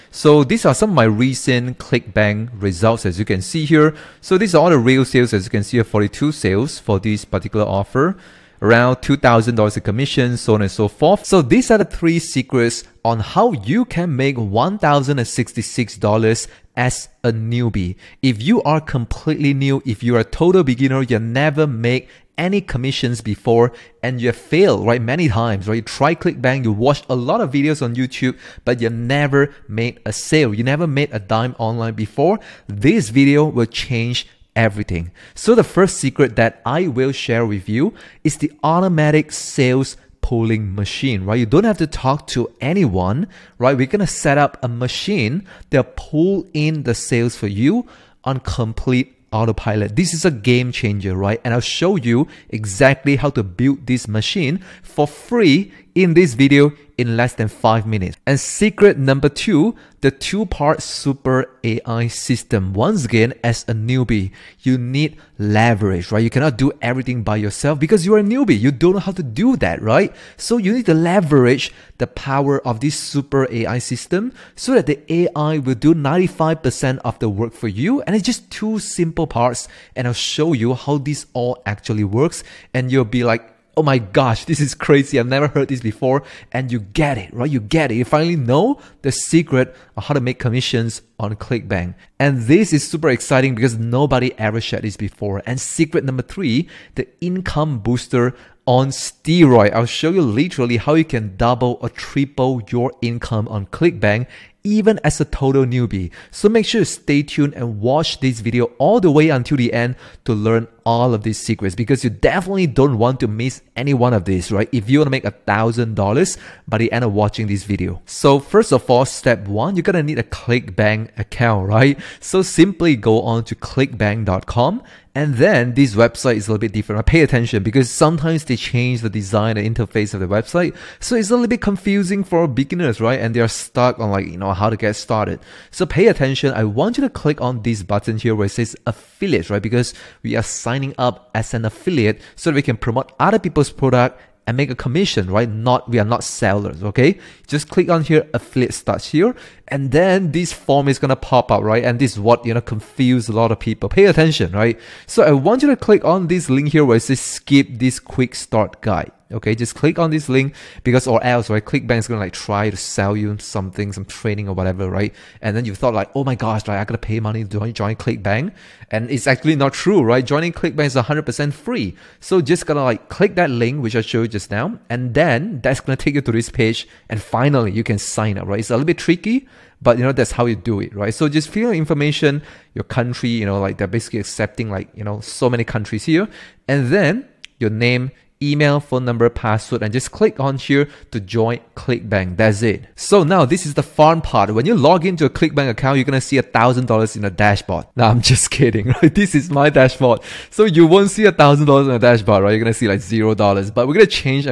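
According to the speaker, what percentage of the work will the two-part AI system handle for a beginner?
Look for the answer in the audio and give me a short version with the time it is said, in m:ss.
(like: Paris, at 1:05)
95%, at 1:15.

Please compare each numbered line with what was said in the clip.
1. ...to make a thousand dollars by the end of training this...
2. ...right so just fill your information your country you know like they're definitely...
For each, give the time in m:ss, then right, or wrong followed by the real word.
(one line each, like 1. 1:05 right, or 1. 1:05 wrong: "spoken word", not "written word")
1. 1:55 wrong: "watching", not "training"
2. 3:00 wrong: "basically", not "definitely".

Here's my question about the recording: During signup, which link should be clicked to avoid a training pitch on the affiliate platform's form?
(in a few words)
Skip this quick start guide.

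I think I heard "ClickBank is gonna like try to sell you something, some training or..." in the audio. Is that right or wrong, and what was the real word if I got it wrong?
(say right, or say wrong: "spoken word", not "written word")
right.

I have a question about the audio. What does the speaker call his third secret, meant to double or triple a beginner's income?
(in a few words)
Income booster on steroid.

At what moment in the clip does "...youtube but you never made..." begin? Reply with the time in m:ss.
0:27.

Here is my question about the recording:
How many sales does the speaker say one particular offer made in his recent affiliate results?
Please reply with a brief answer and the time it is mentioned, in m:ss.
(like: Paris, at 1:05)
42, at 0:05.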